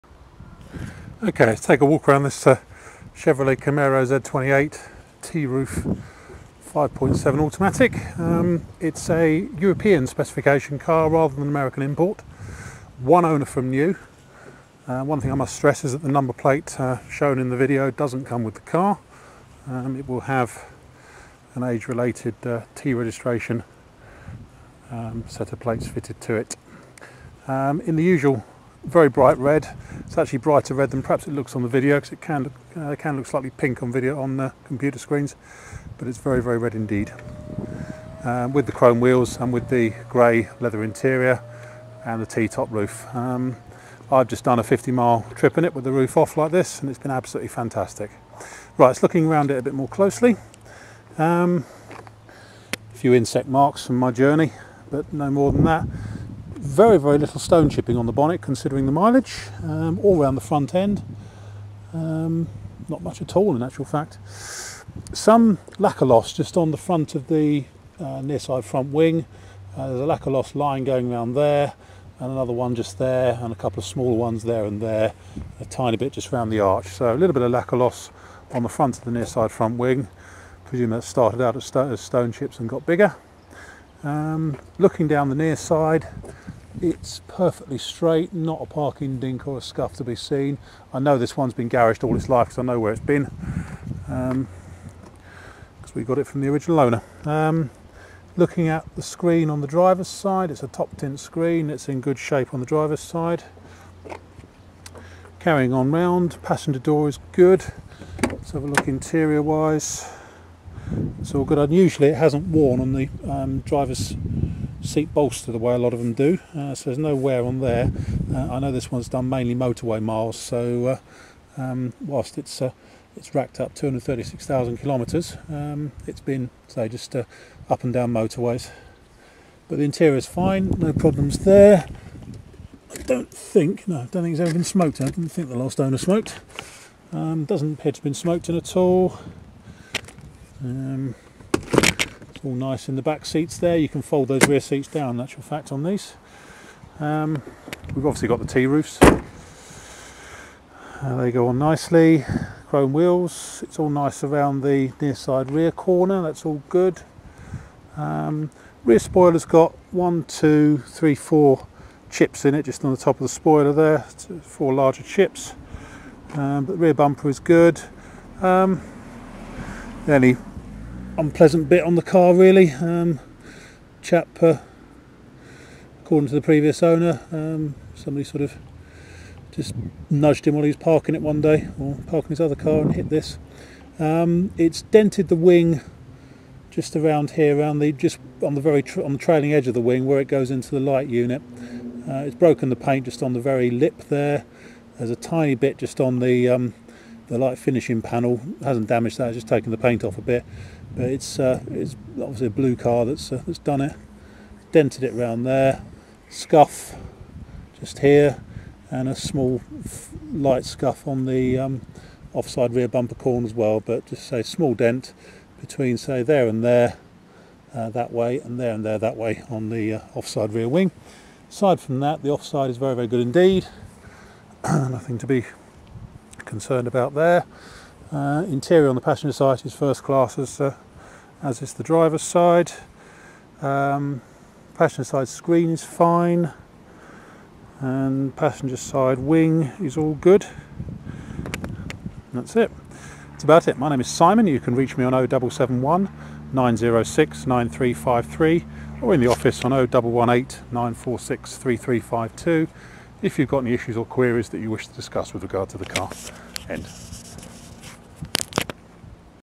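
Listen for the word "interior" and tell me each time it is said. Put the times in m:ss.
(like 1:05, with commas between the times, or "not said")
0:40, 1:48, 2:09, 3:48.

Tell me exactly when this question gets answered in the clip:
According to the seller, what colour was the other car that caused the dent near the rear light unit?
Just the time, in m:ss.
3:22.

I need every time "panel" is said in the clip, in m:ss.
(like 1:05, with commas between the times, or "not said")
3:18.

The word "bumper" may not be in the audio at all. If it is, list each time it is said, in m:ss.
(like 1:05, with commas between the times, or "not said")
2:46, 3:32.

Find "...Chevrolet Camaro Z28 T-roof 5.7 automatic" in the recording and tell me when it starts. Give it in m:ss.
0:03.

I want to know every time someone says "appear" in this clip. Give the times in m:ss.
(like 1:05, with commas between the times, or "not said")
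2:17.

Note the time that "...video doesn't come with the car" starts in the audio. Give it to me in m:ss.
0:17.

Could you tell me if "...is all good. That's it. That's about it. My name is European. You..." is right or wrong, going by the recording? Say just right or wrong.
wrong.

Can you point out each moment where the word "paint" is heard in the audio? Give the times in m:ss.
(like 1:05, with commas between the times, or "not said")
3:12, 3:19.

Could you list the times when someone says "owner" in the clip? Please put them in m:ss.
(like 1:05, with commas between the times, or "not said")
0:13, 1:36, 2:15, 2:56.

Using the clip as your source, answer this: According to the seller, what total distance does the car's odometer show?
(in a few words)
236,000 kilometres.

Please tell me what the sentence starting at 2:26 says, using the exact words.
Um, we've obviously got the T-roofs.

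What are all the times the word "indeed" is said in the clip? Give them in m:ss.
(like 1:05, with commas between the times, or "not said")
0:36, 3:43.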